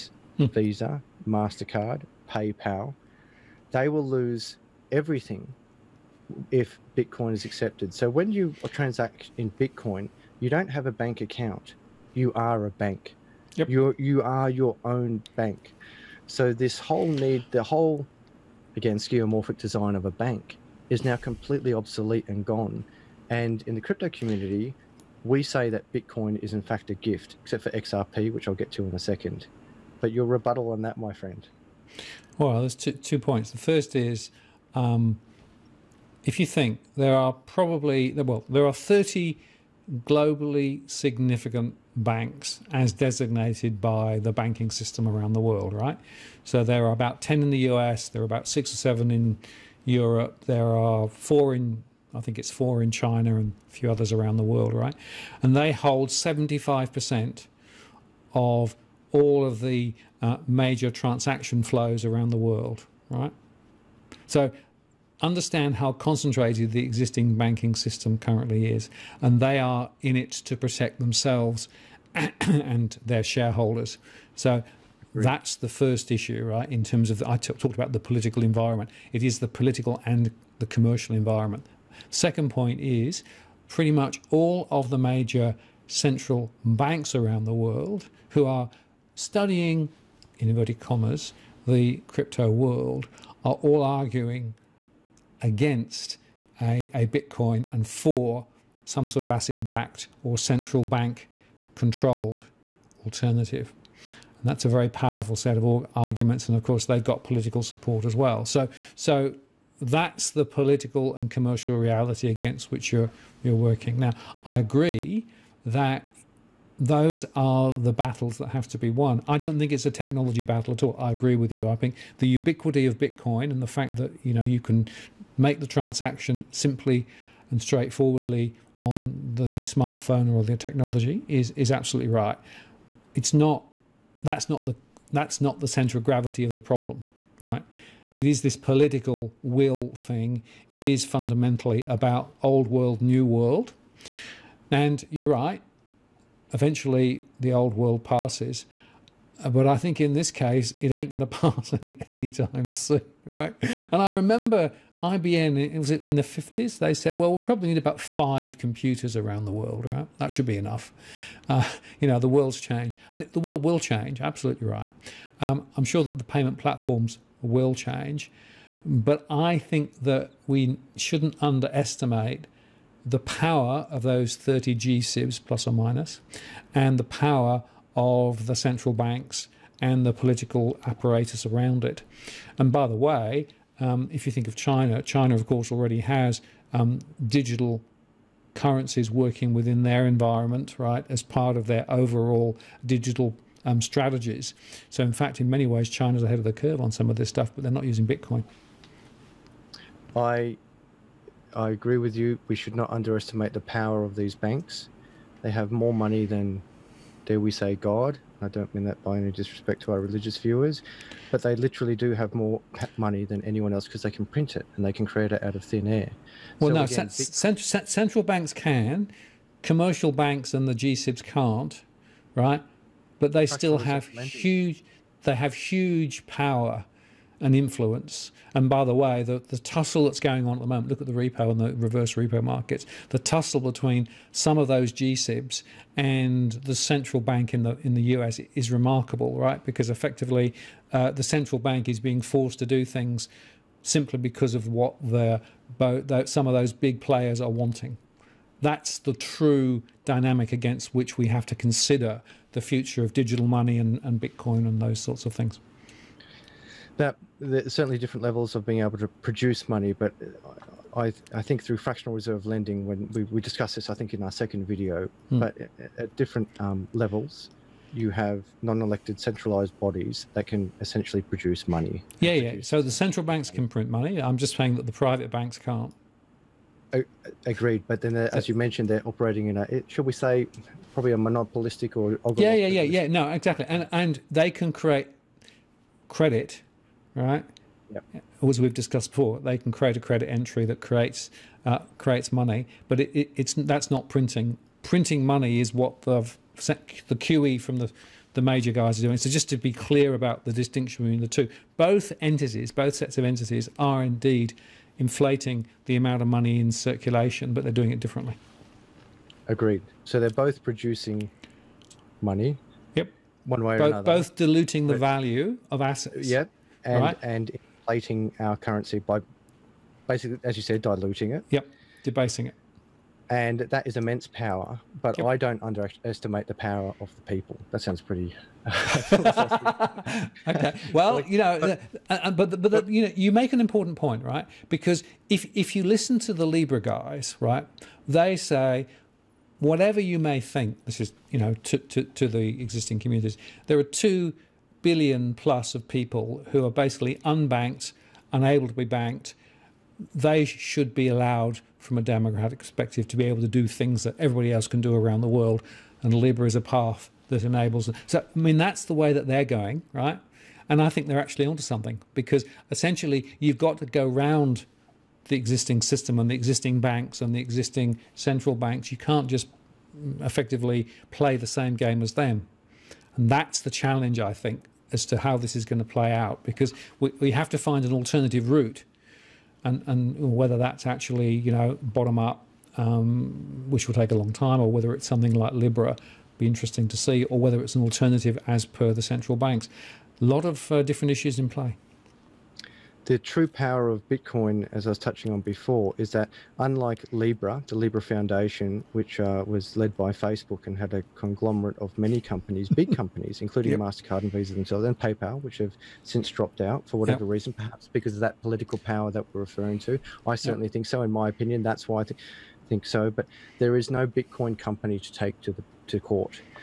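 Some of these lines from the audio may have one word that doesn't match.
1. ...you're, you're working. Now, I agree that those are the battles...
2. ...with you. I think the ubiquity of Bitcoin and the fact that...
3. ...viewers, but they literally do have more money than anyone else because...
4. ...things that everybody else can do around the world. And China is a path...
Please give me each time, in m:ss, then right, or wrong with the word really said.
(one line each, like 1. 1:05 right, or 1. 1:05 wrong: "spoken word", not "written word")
1. 1:52 right
2. 2:01 right
3. 3:30 right
4. 5:53 wrong: "Libra", not "China".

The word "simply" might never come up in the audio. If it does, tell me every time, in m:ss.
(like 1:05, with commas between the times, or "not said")
2:06, 4:03.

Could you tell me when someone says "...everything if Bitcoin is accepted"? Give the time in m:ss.
0:04.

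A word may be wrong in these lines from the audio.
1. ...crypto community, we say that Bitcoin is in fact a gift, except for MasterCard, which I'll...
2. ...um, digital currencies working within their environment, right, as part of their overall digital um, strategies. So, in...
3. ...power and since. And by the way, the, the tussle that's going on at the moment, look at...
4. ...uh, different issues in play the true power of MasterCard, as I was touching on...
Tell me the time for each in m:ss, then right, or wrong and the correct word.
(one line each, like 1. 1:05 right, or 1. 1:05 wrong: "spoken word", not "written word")
1. 0:23 wrong: "XRP", not "MasterCard"
2. 3:06 right
3. 3:46 wrong: "influence", not "since"
4. 6:30 wrong: "Bitcoin", not "MasterCard".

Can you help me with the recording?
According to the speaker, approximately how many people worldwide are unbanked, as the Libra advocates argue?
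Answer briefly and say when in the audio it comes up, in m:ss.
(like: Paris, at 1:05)
2 billion, at 5:43.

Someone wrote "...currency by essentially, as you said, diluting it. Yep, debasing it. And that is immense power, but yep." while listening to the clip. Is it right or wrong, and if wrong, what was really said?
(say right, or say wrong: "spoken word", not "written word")
wrong: "basically", not "essentially".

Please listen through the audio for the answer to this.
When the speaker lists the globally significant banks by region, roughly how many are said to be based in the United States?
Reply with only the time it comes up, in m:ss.
0:46.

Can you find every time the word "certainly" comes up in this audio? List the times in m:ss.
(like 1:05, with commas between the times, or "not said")
4:17, 6:50.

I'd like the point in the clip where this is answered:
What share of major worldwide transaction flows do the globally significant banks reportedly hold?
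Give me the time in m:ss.
0:56.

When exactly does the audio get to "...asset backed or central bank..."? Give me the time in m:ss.
1:39.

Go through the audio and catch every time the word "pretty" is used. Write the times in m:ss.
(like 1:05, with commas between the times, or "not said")
1:23, 5:27.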